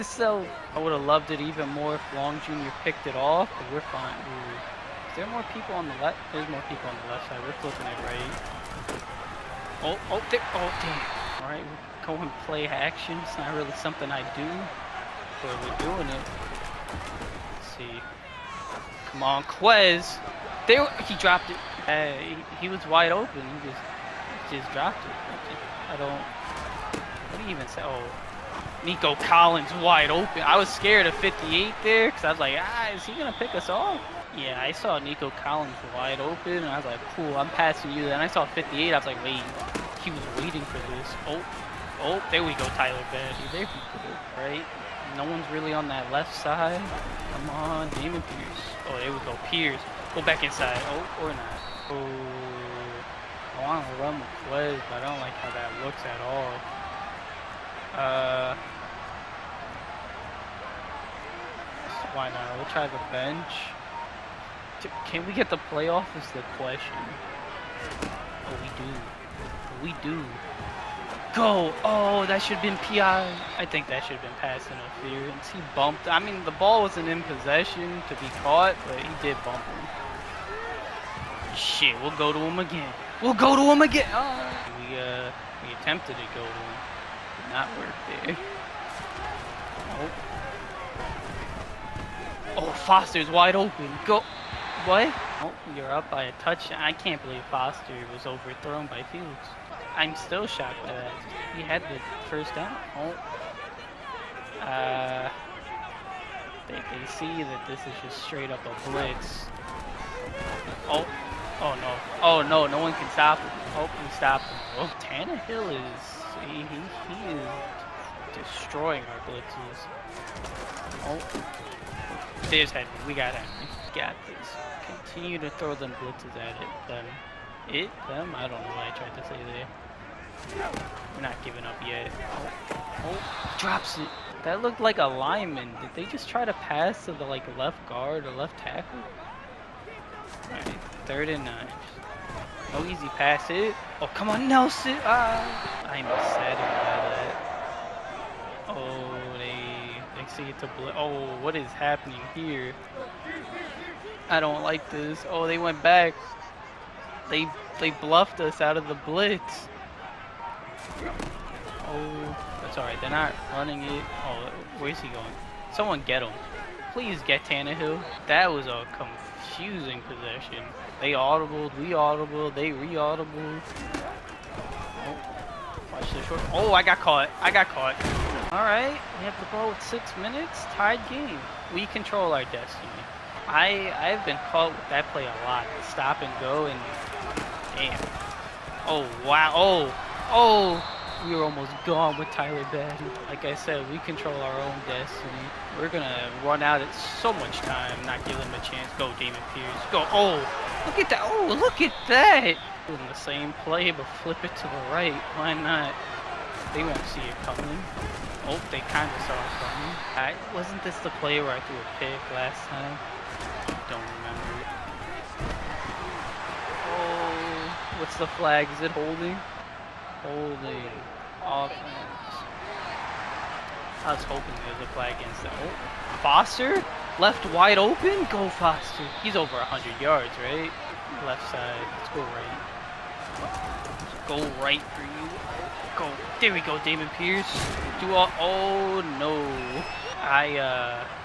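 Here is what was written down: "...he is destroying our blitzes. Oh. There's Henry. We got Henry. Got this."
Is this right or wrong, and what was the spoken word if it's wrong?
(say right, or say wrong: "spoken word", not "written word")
right.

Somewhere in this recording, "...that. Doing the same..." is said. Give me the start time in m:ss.
3:22.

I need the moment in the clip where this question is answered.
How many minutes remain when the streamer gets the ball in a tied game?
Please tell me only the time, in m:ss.
2:59.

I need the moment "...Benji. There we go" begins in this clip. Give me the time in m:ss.
0:43.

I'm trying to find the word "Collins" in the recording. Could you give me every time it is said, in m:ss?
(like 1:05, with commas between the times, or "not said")
0:29, 0:35.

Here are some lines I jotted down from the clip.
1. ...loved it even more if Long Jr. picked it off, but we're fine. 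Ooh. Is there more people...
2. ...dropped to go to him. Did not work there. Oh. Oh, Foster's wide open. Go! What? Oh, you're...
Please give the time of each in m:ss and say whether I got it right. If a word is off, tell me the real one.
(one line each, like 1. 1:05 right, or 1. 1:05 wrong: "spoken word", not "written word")
1. 0:01 right
2. 1:25 wrong: "attempted", not "dropped".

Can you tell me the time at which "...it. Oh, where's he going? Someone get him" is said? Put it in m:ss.
2:43.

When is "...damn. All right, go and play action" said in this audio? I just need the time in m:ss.
0:10.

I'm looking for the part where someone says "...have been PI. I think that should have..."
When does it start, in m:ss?
1:12.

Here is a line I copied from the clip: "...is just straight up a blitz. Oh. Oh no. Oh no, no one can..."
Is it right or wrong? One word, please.
right.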